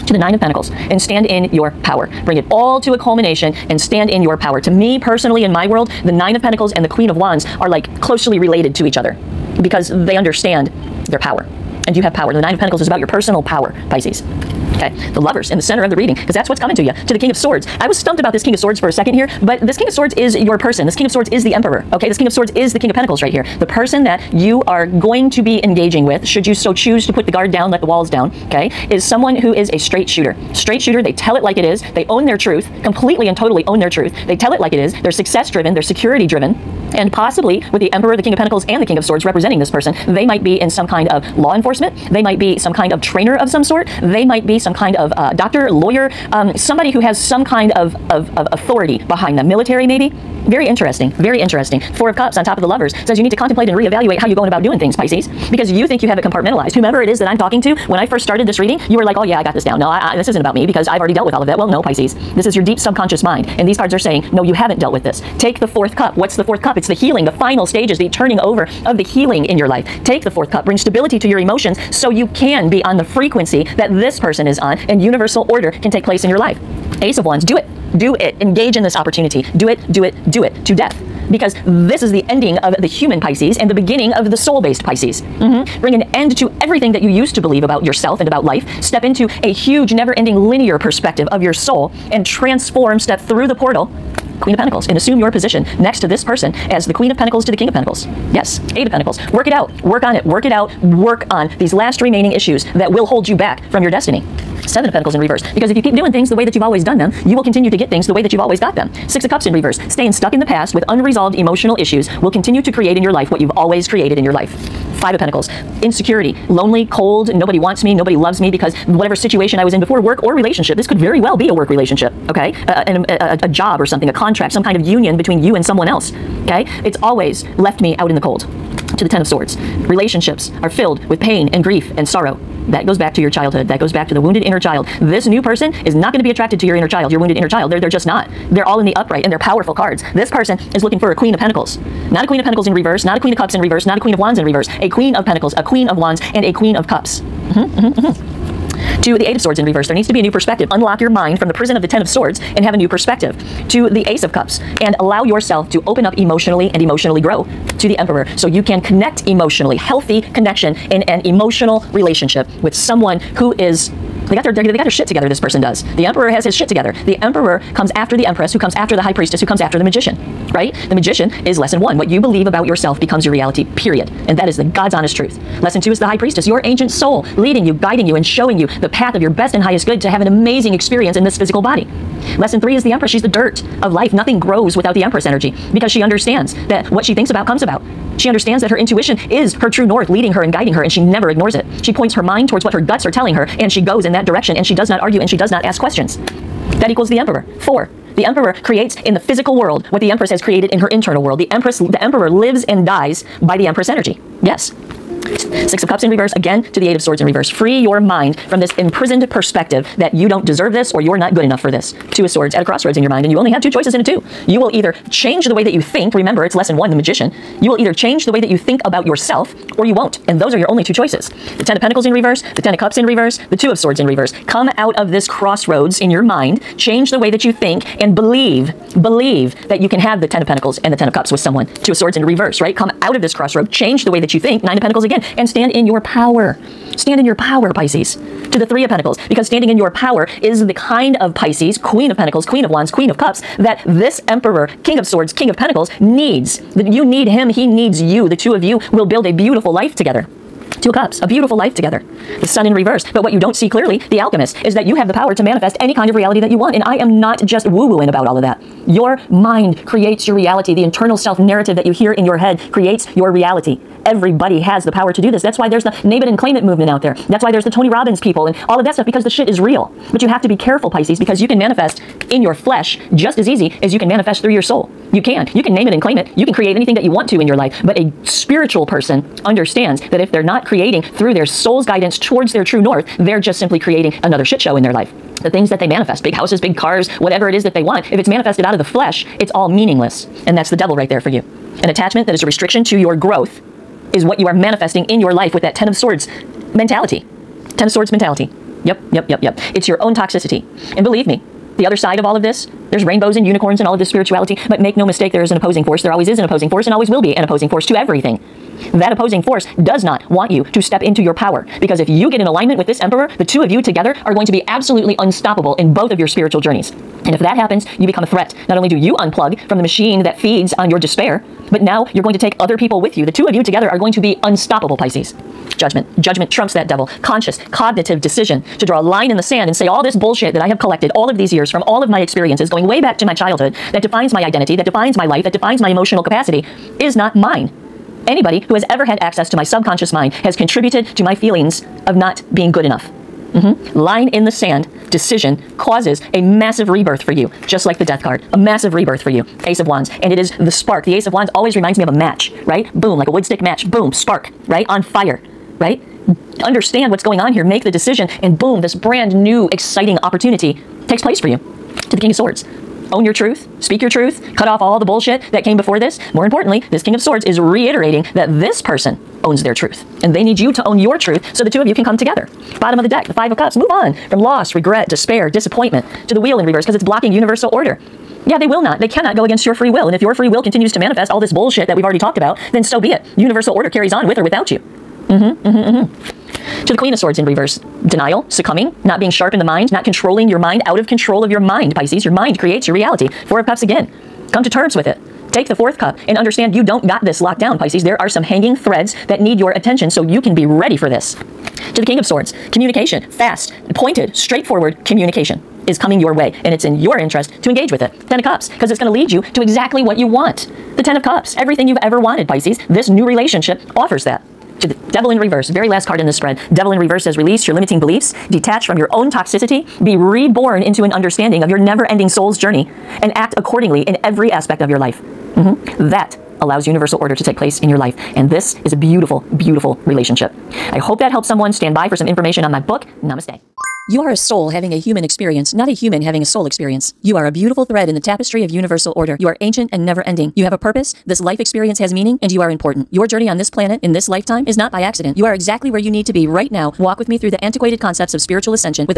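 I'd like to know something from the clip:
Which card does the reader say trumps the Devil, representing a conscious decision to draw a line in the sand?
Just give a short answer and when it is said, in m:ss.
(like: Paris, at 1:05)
Judgment, at 5:26.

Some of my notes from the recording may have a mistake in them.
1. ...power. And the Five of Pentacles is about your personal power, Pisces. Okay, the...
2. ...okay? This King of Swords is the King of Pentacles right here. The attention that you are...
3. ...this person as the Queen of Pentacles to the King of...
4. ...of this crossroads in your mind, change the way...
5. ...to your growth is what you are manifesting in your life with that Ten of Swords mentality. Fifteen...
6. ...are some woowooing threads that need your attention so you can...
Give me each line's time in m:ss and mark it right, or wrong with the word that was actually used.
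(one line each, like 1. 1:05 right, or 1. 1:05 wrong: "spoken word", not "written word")
1. 0:12 wrong: "Nine", not "Five"
2. 0:21 wrong: "person", not "attention"
3. 1:36 right
4. 3:44 right
5. 4:52 wrong: "Ten", not "Fifteen"
6. 6:38 wrong: "hanging", not "woowooing".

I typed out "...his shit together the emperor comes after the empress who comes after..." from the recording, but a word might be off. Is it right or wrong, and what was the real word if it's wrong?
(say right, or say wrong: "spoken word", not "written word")
right.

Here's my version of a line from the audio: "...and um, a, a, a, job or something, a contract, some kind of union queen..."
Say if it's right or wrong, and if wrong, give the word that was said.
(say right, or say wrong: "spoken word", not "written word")
wrong: "between", not "queen".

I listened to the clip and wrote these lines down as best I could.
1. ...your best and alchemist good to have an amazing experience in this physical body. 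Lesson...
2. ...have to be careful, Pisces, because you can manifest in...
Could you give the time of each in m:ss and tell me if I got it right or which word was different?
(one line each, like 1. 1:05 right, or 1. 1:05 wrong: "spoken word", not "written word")
1. 2:59 wrong: "highest", not "alchemist"
2. 4:30 right.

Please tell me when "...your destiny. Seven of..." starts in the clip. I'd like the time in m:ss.
1:43.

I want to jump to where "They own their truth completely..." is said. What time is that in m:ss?
0:31.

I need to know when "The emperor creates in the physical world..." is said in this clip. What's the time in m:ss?
3:18.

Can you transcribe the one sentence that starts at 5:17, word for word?
And if that happens, you become a threat.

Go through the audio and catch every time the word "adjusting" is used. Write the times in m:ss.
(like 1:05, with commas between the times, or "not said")
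not said.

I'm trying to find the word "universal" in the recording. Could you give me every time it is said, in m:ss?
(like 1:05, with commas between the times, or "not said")
1:15, 6:17, 6:23, 7:06, 7:18.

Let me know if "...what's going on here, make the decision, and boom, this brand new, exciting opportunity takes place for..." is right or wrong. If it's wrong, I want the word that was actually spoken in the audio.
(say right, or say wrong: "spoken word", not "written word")
right.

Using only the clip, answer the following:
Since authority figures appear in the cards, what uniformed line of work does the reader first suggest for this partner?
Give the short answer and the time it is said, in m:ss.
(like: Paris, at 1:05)
Law enforcement, at 0:41.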